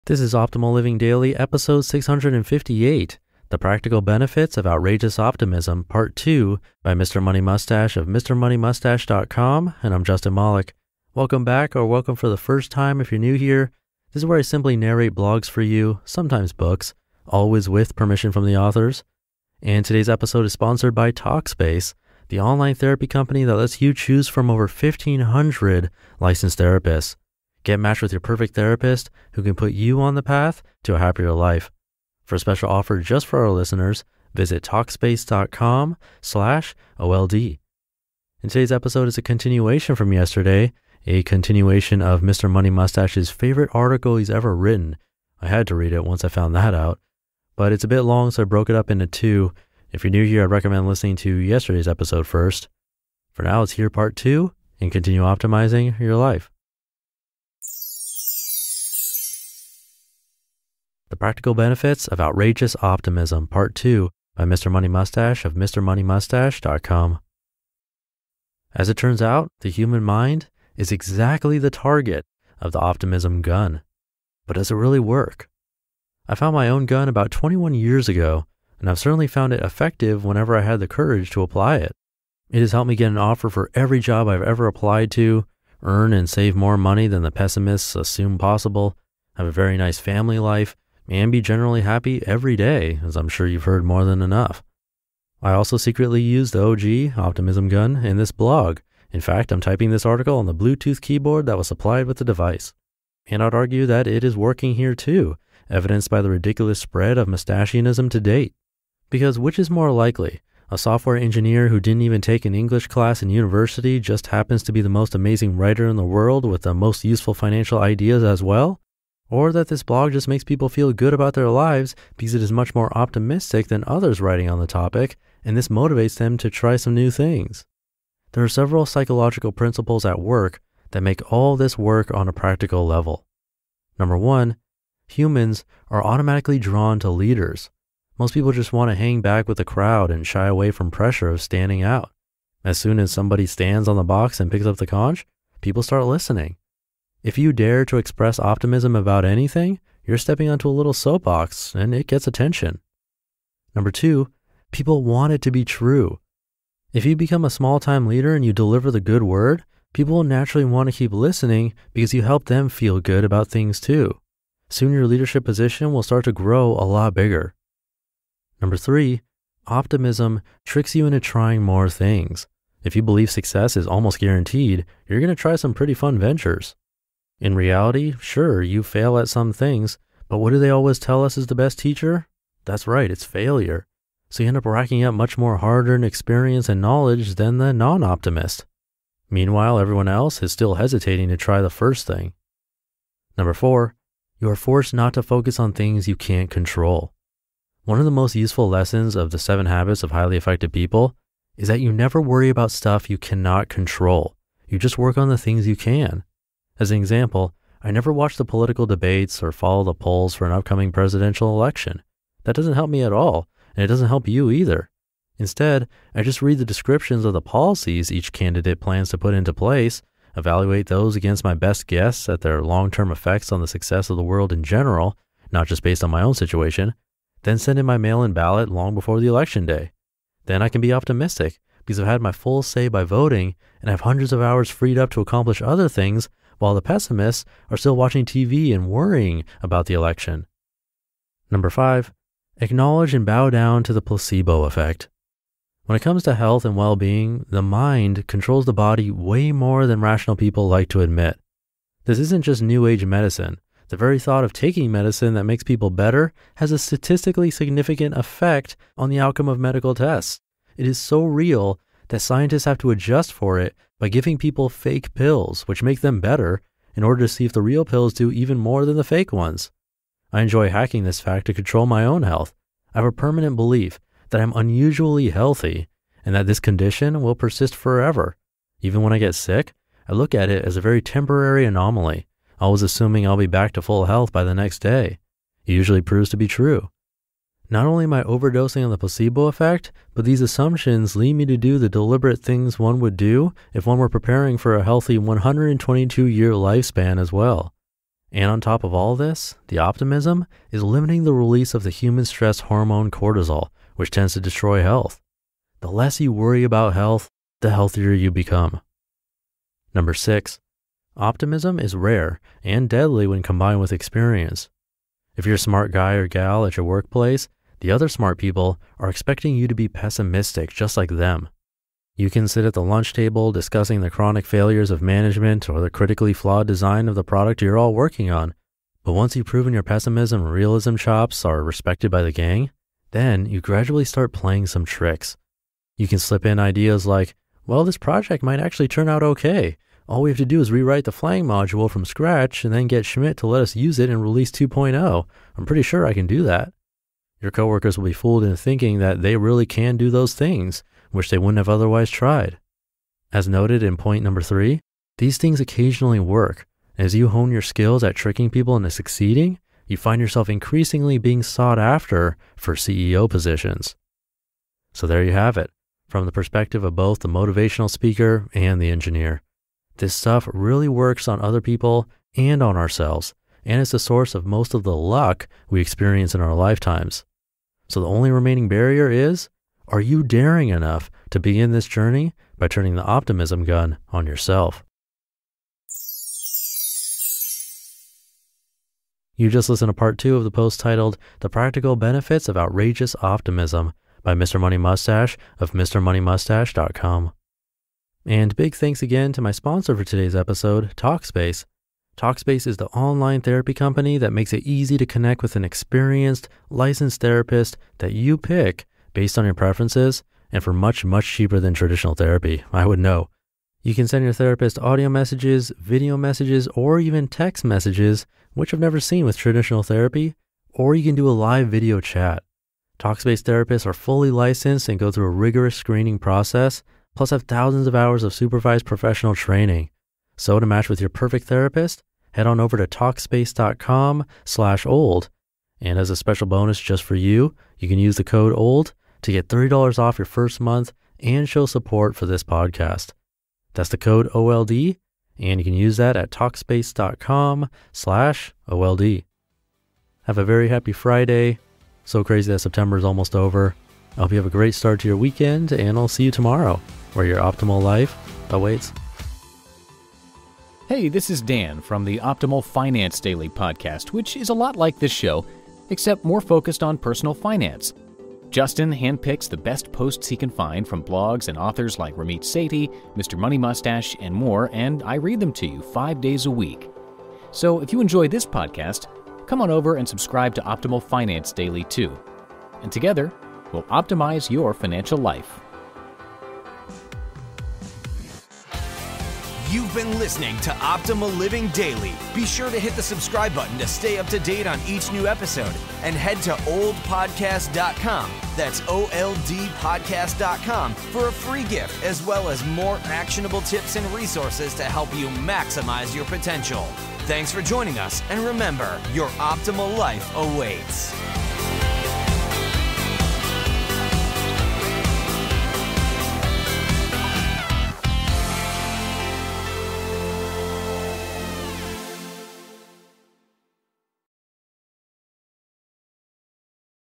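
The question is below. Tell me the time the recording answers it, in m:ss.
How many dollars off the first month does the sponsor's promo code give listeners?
7:19.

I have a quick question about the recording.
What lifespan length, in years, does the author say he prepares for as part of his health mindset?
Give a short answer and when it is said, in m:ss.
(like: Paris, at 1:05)
122, at 4:55.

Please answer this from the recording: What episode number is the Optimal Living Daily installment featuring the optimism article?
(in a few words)
658.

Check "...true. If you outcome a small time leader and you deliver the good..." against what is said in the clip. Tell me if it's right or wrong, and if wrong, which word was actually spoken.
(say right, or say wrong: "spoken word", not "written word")
wrong: "become", not "outcome".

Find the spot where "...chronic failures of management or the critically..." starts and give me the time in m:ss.
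5:24.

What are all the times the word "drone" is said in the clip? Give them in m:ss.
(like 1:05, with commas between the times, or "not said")
not said.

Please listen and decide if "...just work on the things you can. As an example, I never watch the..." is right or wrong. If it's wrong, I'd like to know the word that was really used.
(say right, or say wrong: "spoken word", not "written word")
right.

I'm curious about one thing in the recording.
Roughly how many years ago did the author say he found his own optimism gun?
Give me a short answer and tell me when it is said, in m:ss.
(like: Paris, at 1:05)
21, at 1:17.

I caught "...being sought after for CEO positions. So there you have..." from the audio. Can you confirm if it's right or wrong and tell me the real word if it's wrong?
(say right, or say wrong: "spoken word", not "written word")
right.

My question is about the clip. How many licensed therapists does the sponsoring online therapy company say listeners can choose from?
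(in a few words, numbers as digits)
1,500.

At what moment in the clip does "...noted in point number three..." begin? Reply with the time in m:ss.
5:53.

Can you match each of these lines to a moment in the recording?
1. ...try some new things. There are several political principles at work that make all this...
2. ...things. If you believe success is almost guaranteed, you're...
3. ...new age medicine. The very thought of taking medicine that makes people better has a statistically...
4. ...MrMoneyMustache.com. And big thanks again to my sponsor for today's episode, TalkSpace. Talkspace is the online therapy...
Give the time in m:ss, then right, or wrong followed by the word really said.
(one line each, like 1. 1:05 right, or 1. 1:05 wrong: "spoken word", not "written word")
1. 2:06 wrong: "psychological", not "political"
2. 2:51 right
3. 4:12 right
4. 6:35 right.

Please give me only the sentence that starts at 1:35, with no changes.
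I also secretly use the OG Optimism Gun in this blog.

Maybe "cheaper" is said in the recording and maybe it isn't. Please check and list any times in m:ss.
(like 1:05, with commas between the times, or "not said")
6:51.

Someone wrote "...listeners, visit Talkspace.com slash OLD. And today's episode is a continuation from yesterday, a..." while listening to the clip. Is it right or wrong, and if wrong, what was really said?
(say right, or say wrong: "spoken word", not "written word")
right.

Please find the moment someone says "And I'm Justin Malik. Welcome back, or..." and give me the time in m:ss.
0:09.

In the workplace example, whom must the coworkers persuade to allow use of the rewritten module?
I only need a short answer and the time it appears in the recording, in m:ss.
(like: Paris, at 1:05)
Schmidt, at 5:43.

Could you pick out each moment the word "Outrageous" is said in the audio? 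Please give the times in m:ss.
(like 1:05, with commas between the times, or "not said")
0:04, 1:02, 6:32.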